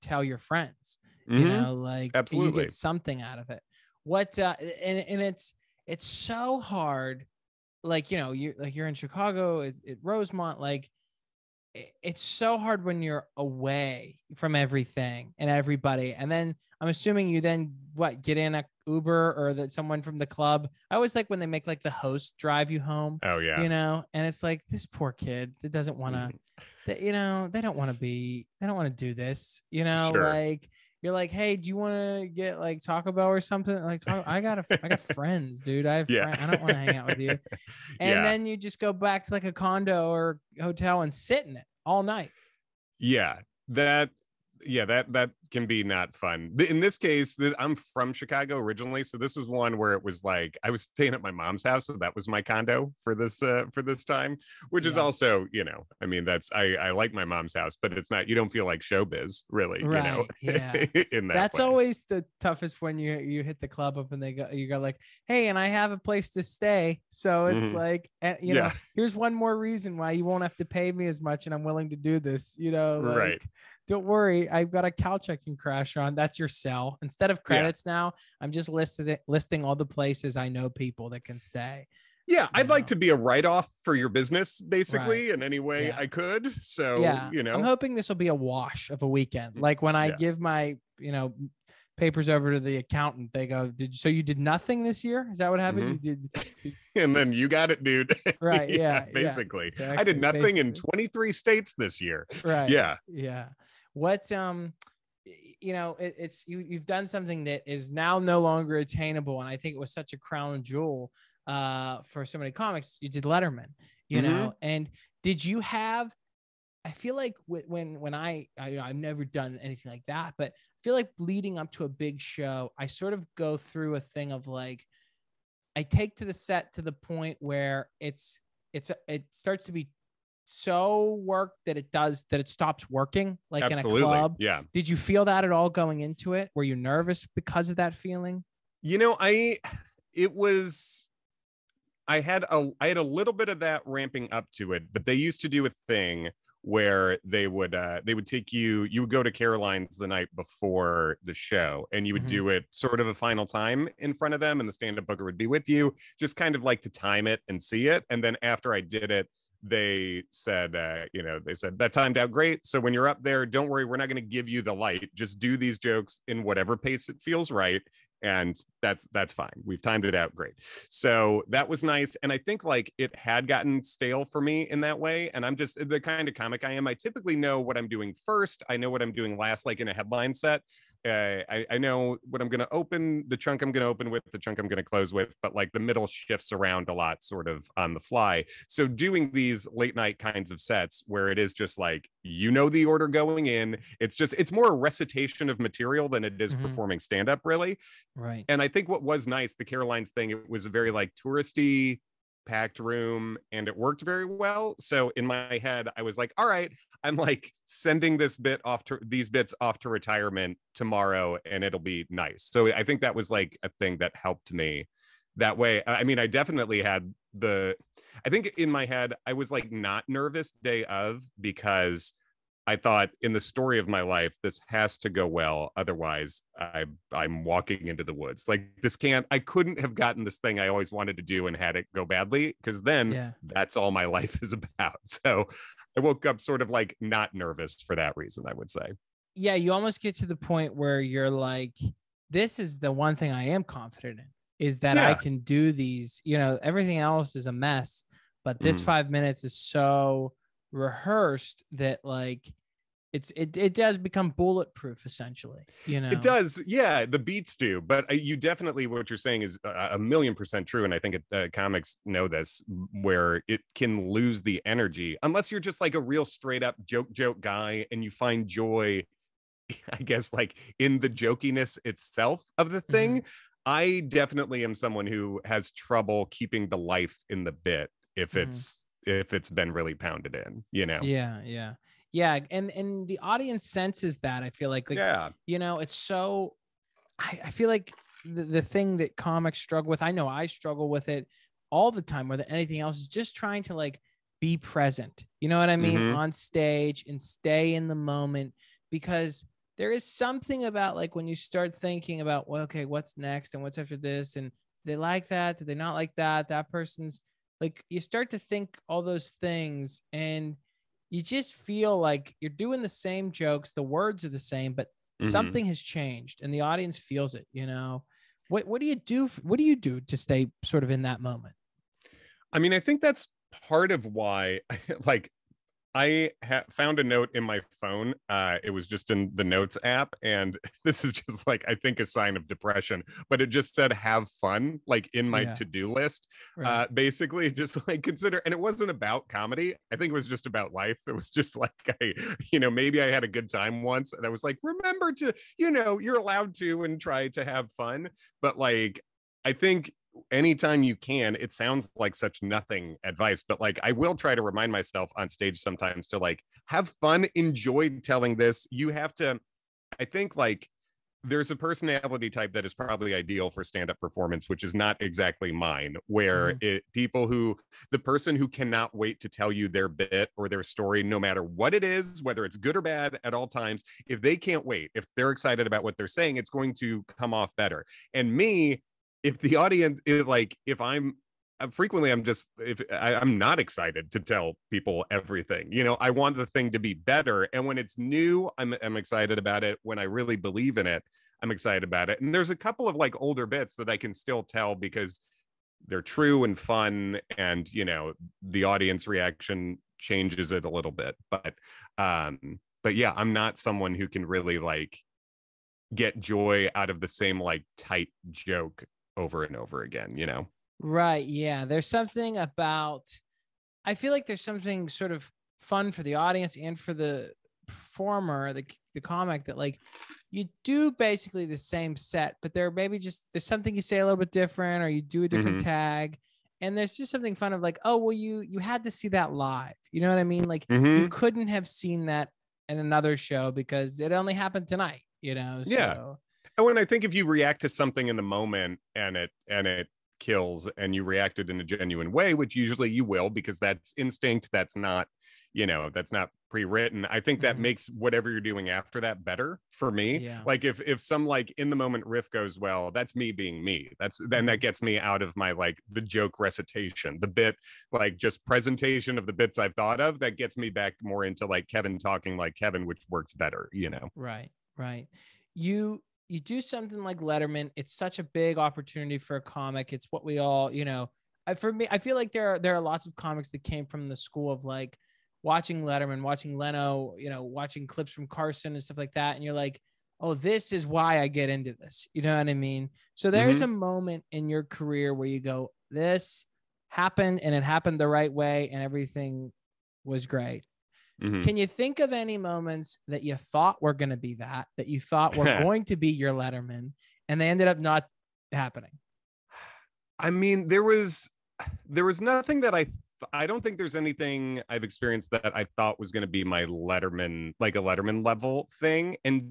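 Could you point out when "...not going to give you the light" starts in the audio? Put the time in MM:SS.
02:43.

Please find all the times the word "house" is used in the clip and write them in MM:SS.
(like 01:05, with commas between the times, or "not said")
00:51, 00:57.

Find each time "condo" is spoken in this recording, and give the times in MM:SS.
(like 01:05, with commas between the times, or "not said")
00:39, 00:52.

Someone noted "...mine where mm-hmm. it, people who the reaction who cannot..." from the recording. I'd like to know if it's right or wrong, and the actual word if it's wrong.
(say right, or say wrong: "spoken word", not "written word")
wrong: "person", not "reaction".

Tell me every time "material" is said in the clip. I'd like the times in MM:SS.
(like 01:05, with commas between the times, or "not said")
03:15.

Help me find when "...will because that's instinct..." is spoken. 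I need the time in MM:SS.
07:23.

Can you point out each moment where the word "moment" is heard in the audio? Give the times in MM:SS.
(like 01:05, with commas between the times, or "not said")
04:57, 05:21, 07:18, 07:31, 08:03, 08:12.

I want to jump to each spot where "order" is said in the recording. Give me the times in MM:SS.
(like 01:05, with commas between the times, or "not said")
03:12.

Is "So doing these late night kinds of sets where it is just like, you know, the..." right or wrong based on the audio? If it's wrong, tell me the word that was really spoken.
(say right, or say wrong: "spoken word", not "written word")
right.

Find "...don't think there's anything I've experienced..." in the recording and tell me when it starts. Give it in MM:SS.
08:23.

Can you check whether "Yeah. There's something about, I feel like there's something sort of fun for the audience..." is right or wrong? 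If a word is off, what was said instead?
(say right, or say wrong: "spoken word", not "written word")
right.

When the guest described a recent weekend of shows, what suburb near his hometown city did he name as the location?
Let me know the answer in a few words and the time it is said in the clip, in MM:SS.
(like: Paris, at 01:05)
Rosemont, at 00:10.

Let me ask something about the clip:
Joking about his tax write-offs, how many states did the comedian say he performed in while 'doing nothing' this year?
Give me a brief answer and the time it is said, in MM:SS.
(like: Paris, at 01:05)
23, at 01:40.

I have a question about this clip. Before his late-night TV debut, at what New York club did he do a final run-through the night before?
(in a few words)
Caroline's.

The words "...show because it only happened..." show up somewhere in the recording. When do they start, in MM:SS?
07:13.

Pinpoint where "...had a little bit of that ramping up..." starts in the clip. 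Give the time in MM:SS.
02:22.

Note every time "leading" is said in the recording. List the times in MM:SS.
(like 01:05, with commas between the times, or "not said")
02:01.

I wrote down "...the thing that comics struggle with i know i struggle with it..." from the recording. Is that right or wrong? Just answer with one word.
right.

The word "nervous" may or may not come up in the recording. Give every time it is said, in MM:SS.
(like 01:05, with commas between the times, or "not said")
02:16, 03:40, 03:57.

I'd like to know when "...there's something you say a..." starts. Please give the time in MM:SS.
07:03.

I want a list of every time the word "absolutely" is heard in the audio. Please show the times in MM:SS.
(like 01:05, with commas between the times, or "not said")
00:02, 02:13.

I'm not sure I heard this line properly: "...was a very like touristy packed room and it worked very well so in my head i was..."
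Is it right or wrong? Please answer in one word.
right.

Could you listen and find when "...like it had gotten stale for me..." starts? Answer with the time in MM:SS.
02:52.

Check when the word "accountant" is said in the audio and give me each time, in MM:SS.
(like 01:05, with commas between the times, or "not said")
01:32.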